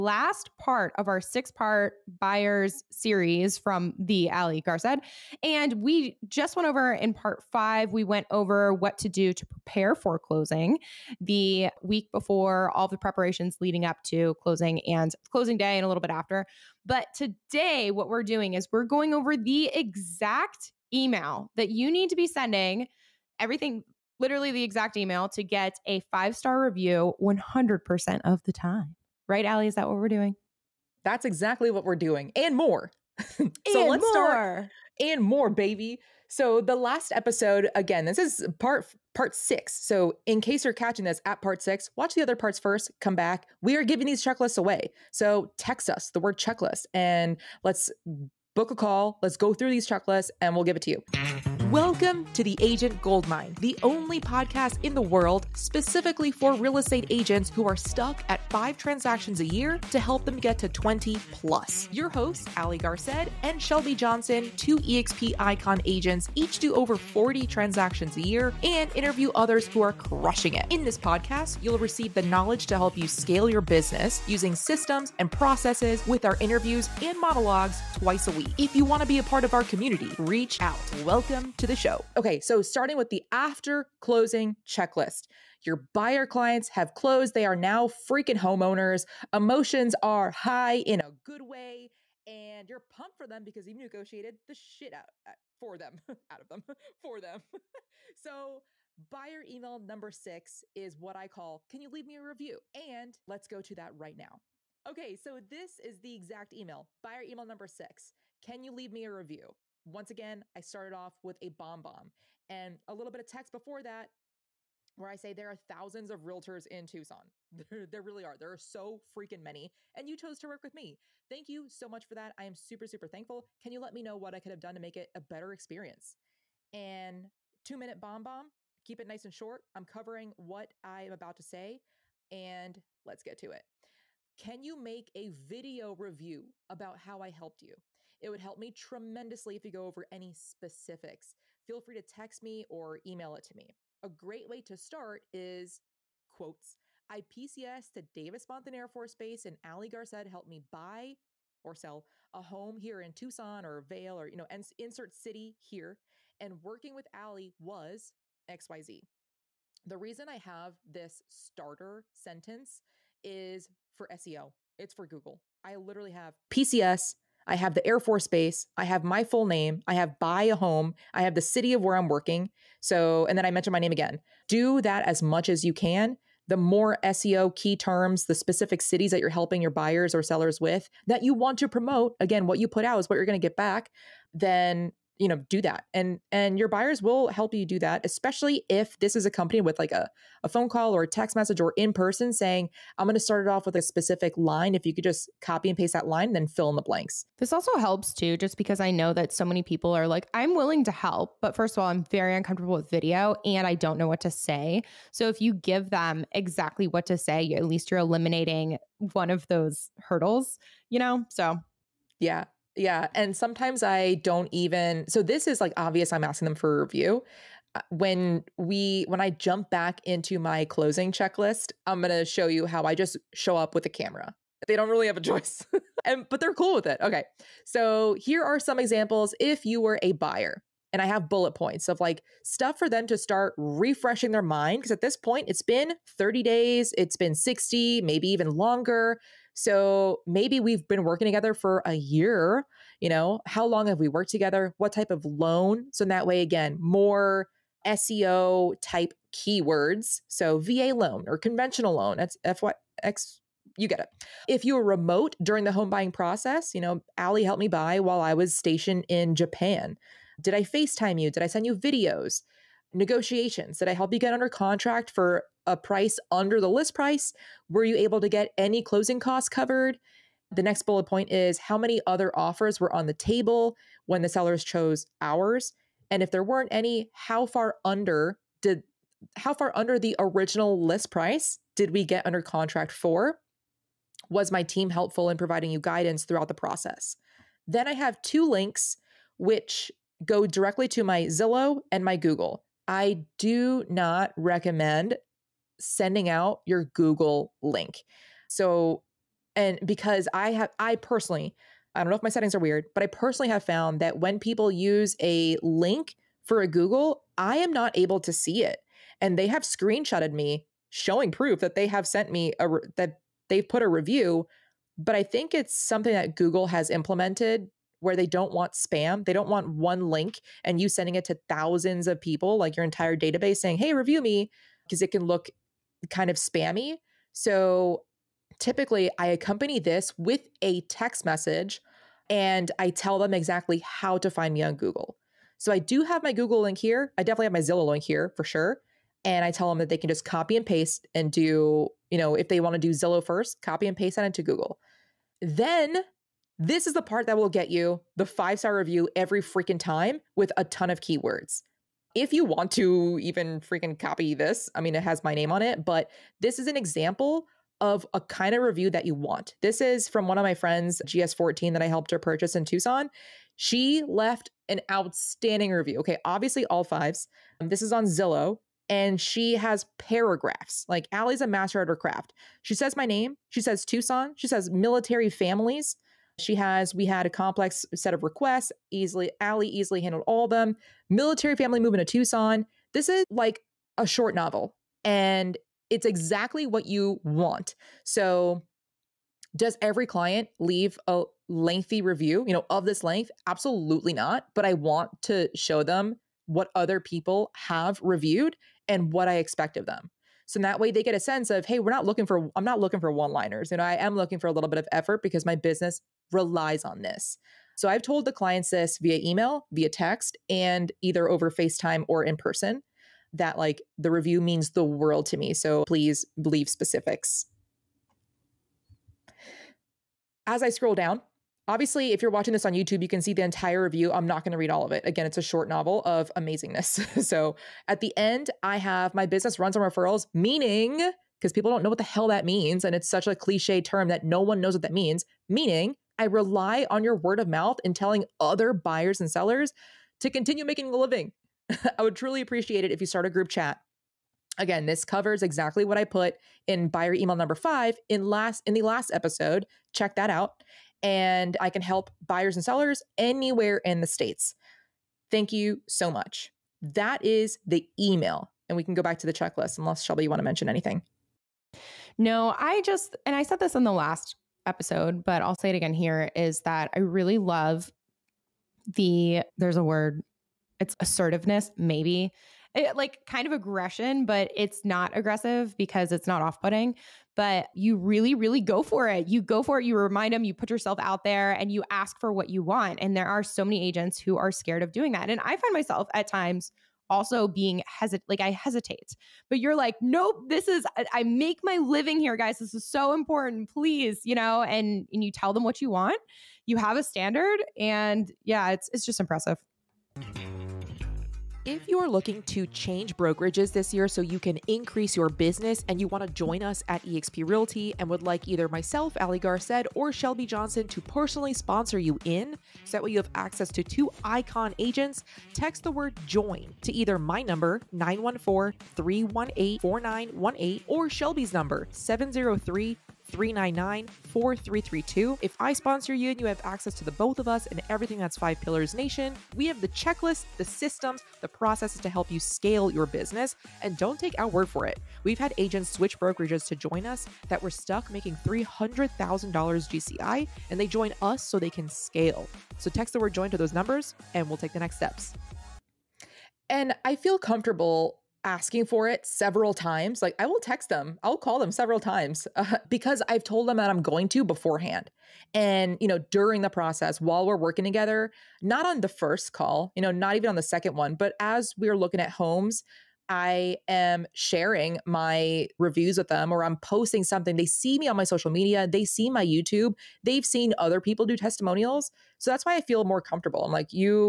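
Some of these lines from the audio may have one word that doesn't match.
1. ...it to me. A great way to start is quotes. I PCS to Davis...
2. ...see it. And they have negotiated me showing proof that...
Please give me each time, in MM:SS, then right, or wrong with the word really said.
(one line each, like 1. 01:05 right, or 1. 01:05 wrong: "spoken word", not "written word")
1. 02:23 right
2. 05:08 wrong: "screenshotted", not "negotiated".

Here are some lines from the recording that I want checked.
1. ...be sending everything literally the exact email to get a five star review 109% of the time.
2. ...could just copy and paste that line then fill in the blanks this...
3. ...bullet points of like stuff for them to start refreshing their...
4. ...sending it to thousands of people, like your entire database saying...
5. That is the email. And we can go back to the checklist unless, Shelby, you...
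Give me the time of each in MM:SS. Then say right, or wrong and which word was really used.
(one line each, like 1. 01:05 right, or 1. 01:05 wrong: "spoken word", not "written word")
1. 00:22 wrong: "100", not "109"
2. 03:14 right
3. 03:51 right
4. 05:20 right
5. 07:36 right.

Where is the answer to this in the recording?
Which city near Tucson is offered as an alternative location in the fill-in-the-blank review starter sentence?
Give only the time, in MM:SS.
02:33.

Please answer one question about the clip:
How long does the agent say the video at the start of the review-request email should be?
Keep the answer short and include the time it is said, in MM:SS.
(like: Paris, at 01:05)
two minute, at 02:07.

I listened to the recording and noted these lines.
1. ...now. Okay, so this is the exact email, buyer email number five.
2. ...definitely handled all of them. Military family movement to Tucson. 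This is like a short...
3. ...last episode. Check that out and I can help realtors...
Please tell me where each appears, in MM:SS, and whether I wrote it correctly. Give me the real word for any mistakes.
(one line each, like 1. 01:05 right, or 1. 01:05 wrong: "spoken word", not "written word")
1. 01:44 wrong: "six", not "five"
2. 06:19 wrong: "easily", not "definitely"
3. 07:28 wrong: "buyers", not "realtors".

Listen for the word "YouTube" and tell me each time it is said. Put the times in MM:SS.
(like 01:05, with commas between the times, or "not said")
07:02, 09:29.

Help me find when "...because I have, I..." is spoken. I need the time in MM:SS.
04:59.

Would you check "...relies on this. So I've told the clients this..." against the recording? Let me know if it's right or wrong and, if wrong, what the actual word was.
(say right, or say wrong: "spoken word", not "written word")
right.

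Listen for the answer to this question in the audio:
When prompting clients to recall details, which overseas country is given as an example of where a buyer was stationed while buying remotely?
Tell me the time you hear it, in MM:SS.
04:19.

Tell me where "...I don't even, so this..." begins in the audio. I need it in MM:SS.
03:33.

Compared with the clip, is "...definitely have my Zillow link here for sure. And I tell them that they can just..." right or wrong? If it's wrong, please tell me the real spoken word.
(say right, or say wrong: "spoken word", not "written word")
right.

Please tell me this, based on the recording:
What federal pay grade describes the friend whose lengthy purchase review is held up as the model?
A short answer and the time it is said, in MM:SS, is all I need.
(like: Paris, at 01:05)
GS14, at 06:01.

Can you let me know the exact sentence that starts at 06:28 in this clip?
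So, does every client leave a lengthy review, you know, of this length?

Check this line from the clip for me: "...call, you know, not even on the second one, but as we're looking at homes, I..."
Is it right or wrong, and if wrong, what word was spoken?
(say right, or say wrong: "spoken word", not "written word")
right.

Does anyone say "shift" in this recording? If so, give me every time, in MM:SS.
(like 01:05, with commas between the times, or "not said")
not said.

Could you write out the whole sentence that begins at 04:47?
Then I have two links which go directly to my Zillow and my Google.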